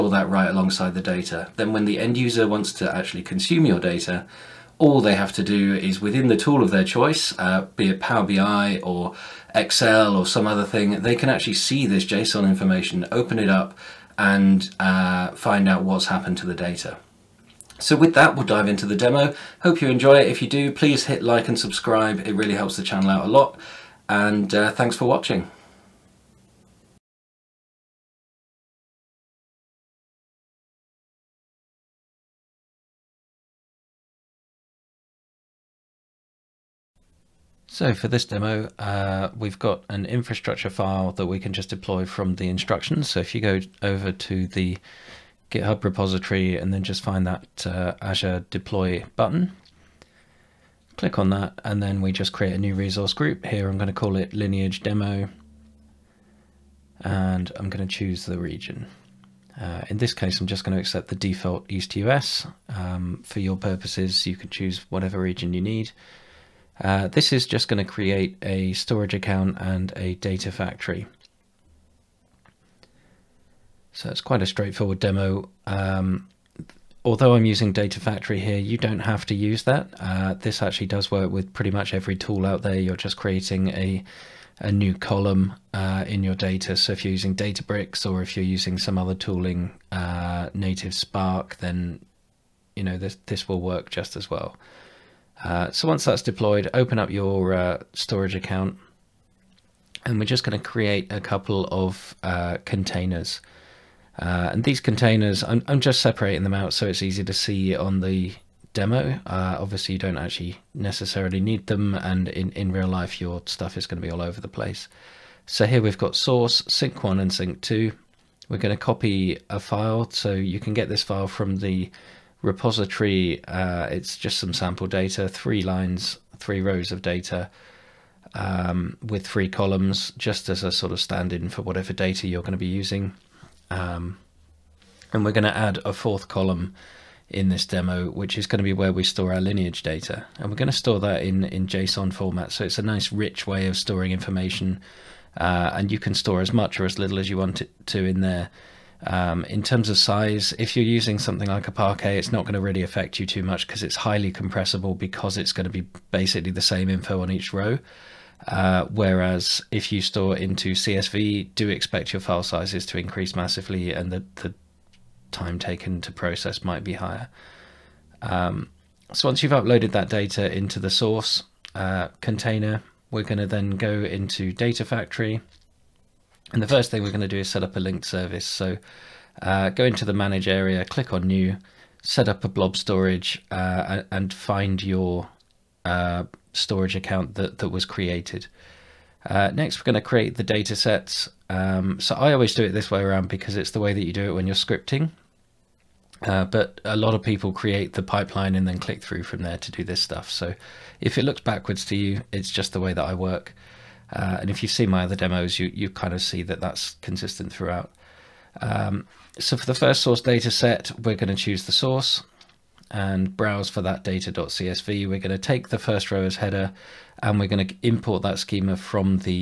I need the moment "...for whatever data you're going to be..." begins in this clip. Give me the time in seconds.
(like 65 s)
131 s.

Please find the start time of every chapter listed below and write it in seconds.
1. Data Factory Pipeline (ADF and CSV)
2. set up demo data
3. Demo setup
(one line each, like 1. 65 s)
1. 134 s
2. 89 s
3. 36 s.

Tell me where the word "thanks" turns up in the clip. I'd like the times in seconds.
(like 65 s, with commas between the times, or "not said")
24 s.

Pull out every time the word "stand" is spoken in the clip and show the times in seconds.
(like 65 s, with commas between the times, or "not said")
131 s.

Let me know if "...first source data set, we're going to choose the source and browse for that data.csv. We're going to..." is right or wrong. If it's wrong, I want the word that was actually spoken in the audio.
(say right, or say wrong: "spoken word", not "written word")
right.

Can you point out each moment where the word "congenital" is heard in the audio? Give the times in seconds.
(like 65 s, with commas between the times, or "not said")
not said.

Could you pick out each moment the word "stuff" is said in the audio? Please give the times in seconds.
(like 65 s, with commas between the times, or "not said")
113 s, 200 s.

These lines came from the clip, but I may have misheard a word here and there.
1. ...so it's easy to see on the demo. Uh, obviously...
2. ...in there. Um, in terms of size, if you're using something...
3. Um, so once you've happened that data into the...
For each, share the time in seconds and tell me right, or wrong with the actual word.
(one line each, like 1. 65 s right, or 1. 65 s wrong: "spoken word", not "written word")
1. 106 s right
2. 148 s right
3. 168 s wrong: "uploaded", not "happened".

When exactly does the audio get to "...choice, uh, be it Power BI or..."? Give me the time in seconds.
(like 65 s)
6 s.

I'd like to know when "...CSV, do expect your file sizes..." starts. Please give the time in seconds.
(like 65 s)
160 s.